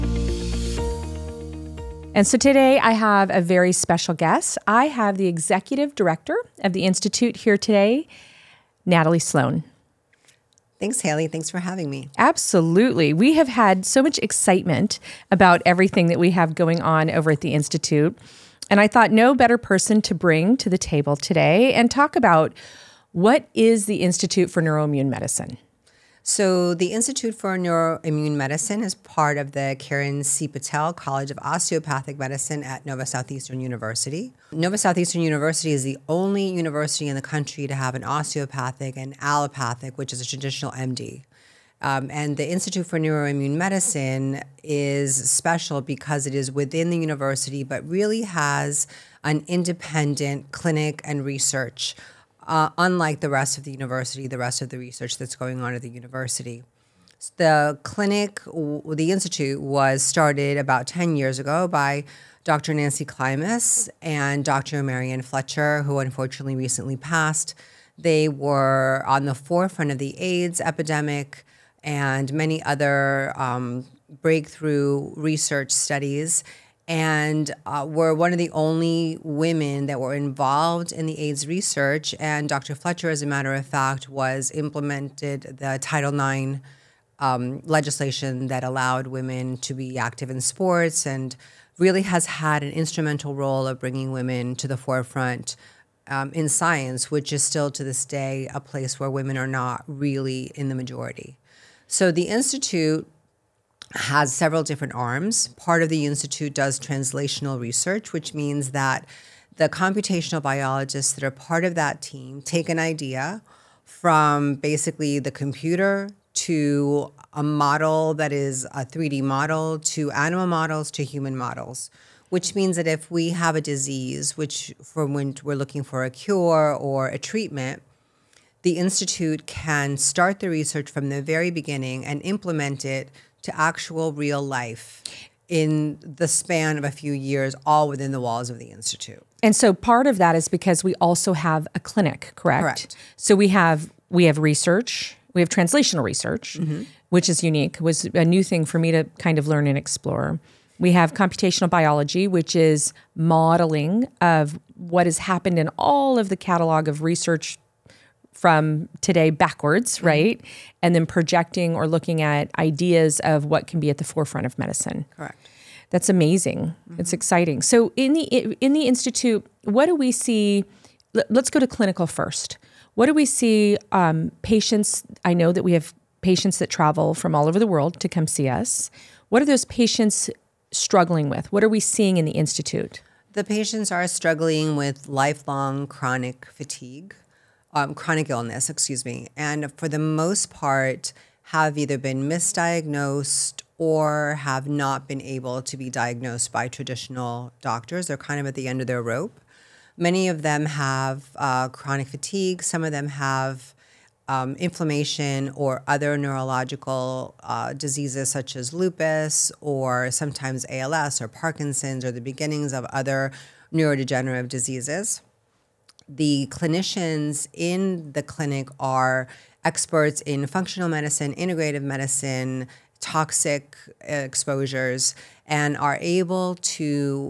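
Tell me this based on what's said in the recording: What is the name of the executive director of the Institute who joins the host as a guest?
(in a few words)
Nathalie Sloane.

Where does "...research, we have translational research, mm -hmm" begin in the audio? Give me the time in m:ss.
2:24.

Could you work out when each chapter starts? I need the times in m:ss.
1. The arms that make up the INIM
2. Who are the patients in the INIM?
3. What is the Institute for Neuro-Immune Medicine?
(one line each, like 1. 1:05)
1. 1:28
2. 2:38
3. 0:13.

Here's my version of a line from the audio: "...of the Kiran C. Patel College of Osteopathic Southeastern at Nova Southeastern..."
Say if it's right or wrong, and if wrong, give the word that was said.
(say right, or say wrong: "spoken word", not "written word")
wrong: "Medicine", not "Southeastern".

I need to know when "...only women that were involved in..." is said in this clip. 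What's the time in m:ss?
1:18.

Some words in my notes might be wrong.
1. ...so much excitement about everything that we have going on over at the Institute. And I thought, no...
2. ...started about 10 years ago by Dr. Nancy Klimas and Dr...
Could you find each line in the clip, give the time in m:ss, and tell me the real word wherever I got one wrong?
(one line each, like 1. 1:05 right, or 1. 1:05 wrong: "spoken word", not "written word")
1. 0:13 right
2. 1:00 right.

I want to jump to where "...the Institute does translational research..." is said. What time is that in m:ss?
1:45.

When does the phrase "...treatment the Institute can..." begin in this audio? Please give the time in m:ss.
2:07.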